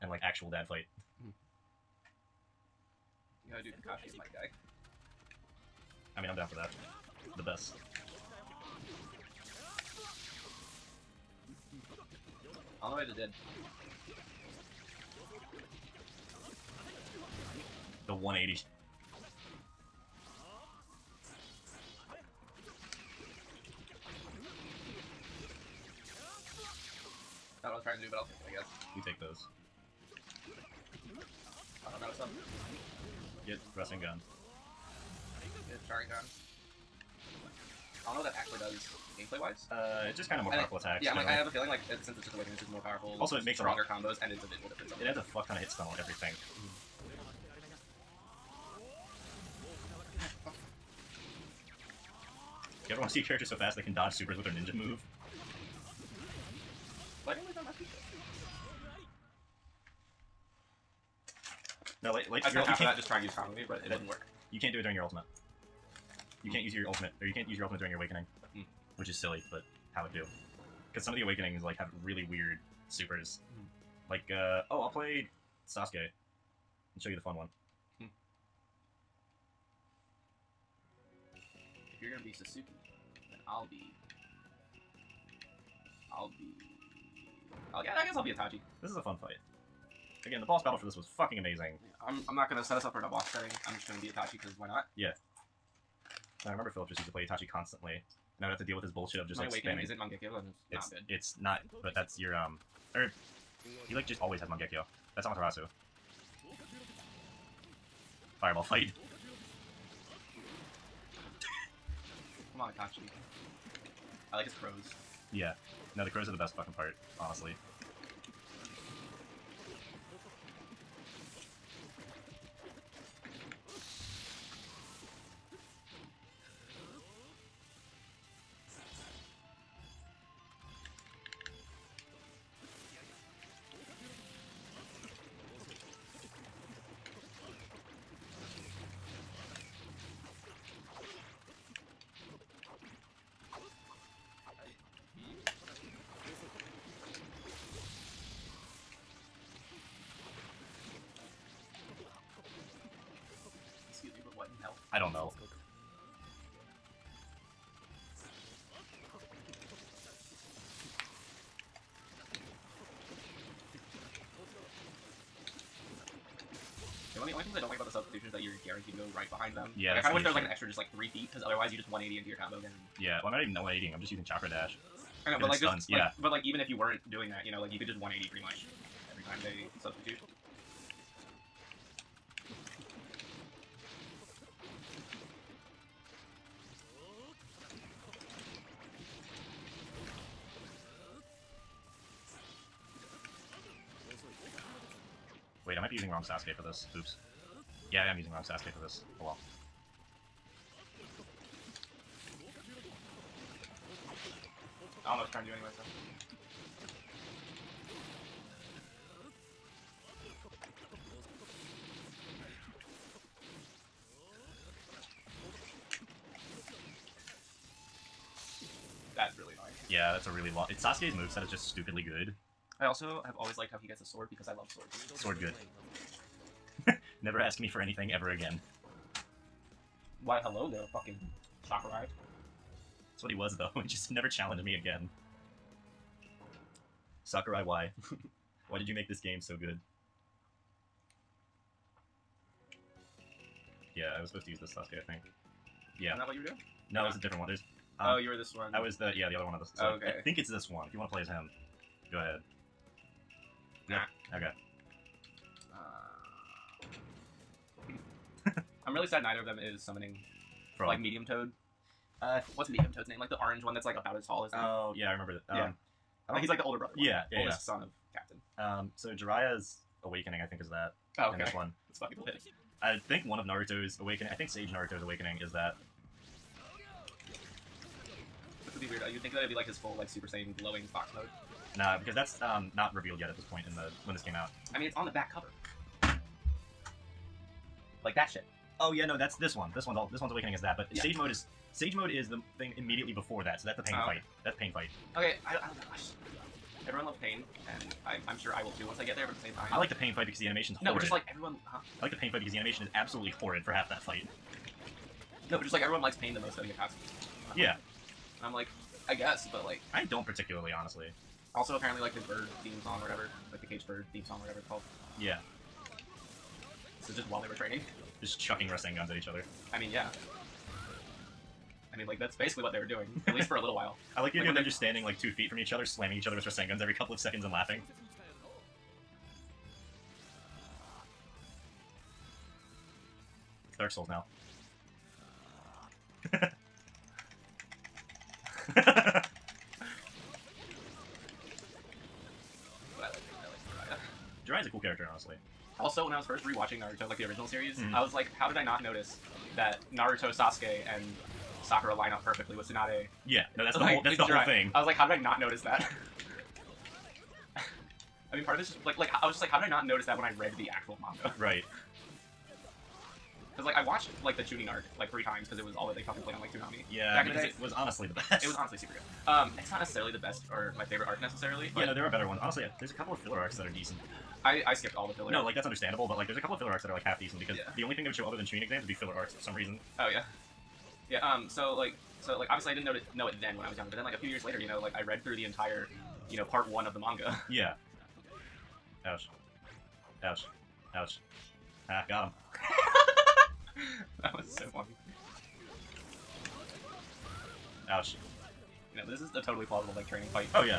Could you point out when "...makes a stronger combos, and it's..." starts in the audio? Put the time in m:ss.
0:43.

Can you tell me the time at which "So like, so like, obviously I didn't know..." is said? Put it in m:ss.
6:21.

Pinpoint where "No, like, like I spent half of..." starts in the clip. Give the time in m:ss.
1:02.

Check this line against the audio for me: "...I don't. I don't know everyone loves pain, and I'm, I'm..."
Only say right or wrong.
right.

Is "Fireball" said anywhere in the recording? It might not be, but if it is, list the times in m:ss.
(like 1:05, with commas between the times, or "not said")
1:48.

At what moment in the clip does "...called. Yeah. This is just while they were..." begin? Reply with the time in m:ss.
5:14.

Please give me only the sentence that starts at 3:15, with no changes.
might be using wrong Sasuke for this.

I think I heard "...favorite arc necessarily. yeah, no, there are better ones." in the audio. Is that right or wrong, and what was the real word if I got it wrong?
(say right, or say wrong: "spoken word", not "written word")
right.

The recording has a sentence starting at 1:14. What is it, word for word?
Like, uh, oh, I'll play Sasuke and show you the fun one.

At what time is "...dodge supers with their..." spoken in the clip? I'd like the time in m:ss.
0:53.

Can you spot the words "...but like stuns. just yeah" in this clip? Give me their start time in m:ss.
2:55.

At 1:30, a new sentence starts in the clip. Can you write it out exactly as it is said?
Again, the boss battle for this was fucking amazing.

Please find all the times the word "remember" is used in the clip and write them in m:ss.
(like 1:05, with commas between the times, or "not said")
1:36, 4:25.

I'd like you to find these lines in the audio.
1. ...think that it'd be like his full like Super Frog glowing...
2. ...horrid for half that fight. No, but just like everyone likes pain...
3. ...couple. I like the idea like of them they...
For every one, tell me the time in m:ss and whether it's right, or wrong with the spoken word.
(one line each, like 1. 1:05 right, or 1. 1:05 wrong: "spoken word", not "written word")
1. 4:39 wrong: "Saiyan", not "Frog"
2. 5:03 right
3. 5:23 wrong: "while", not "couple".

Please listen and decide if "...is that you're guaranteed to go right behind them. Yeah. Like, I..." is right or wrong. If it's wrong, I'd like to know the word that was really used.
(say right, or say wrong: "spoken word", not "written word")
right.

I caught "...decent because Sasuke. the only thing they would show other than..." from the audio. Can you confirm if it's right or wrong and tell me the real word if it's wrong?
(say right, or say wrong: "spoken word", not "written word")
wrong: "Yeah", not "Sasuke".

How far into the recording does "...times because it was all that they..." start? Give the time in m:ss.
6:05.